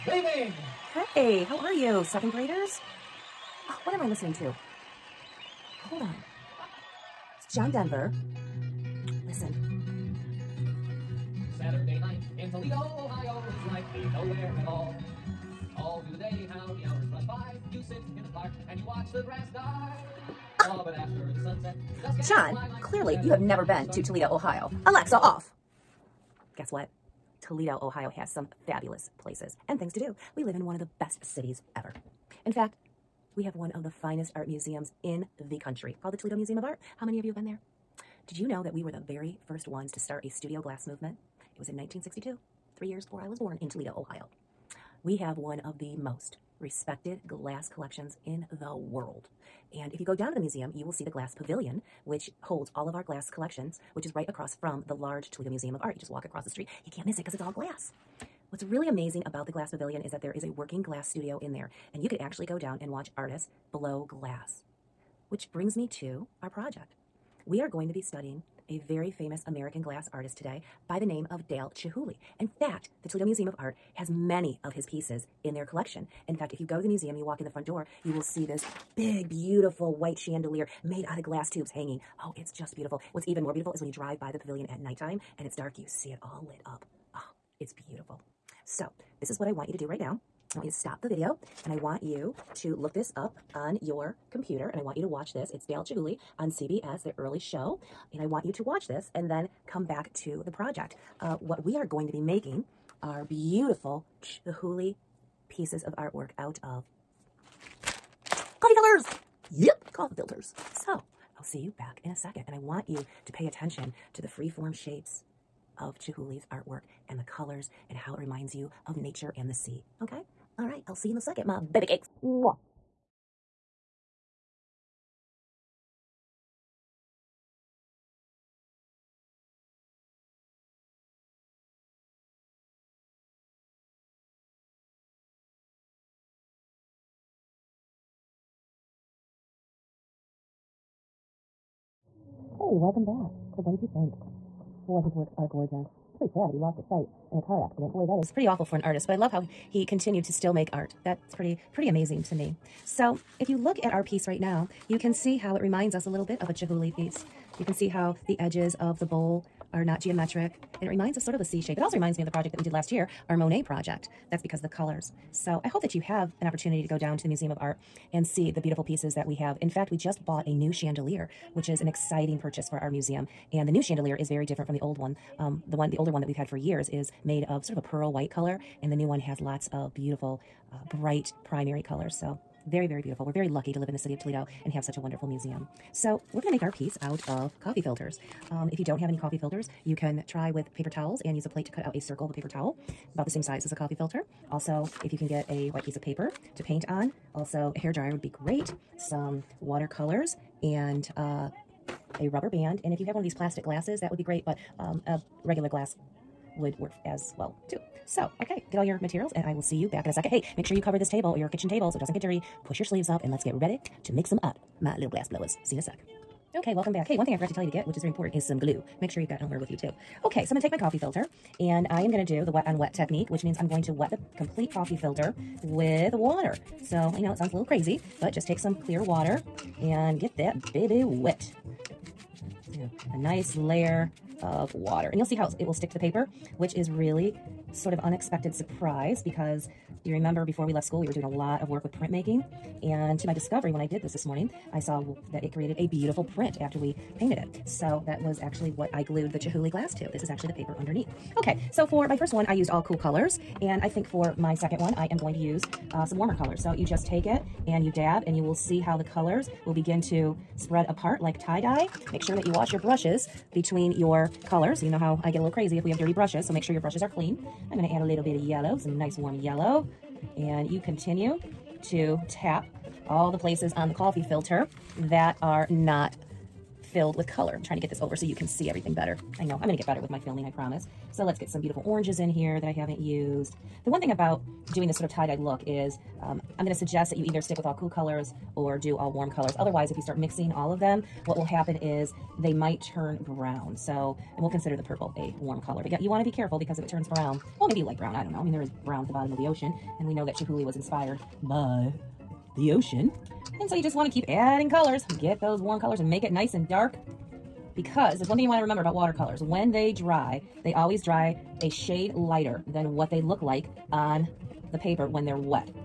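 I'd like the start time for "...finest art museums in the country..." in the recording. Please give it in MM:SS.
00:34.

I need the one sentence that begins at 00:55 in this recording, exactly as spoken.
You just walk across the street.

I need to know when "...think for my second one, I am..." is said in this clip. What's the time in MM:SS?
04:13.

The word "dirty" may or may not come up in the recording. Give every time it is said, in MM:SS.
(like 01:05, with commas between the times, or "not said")
03:32, 04:25.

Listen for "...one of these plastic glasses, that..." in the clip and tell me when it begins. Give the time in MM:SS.
03:23.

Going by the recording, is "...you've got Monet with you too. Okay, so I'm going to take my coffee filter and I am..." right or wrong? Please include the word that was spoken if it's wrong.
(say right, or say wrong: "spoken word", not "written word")
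wrong: "Elmer", not "Monet".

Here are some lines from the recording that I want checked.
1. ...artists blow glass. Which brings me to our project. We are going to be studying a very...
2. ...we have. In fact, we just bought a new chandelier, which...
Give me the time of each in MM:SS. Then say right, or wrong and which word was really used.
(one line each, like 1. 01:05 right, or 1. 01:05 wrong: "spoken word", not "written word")
1. 01:03 right
2. 02:49 right.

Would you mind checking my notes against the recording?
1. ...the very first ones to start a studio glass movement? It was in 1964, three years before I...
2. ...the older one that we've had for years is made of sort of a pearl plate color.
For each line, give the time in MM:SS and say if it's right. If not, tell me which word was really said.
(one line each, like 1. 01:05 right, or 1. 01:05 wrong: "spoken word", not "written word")
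1. 00:38 wrong: "1962", not "1964"
2. 02:55 wrong: "white", not "plate".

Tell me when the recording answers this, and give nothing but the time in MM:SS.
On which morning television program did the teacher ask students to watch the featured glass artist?
01:36.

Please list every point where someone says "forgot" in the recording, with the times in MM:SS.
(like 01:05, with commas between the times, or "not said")
03:37.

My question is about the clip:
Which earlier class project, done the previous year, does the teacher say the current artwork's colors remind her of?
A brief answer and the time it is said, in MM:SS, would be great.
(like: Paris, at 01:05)
Monet project, at 02:43.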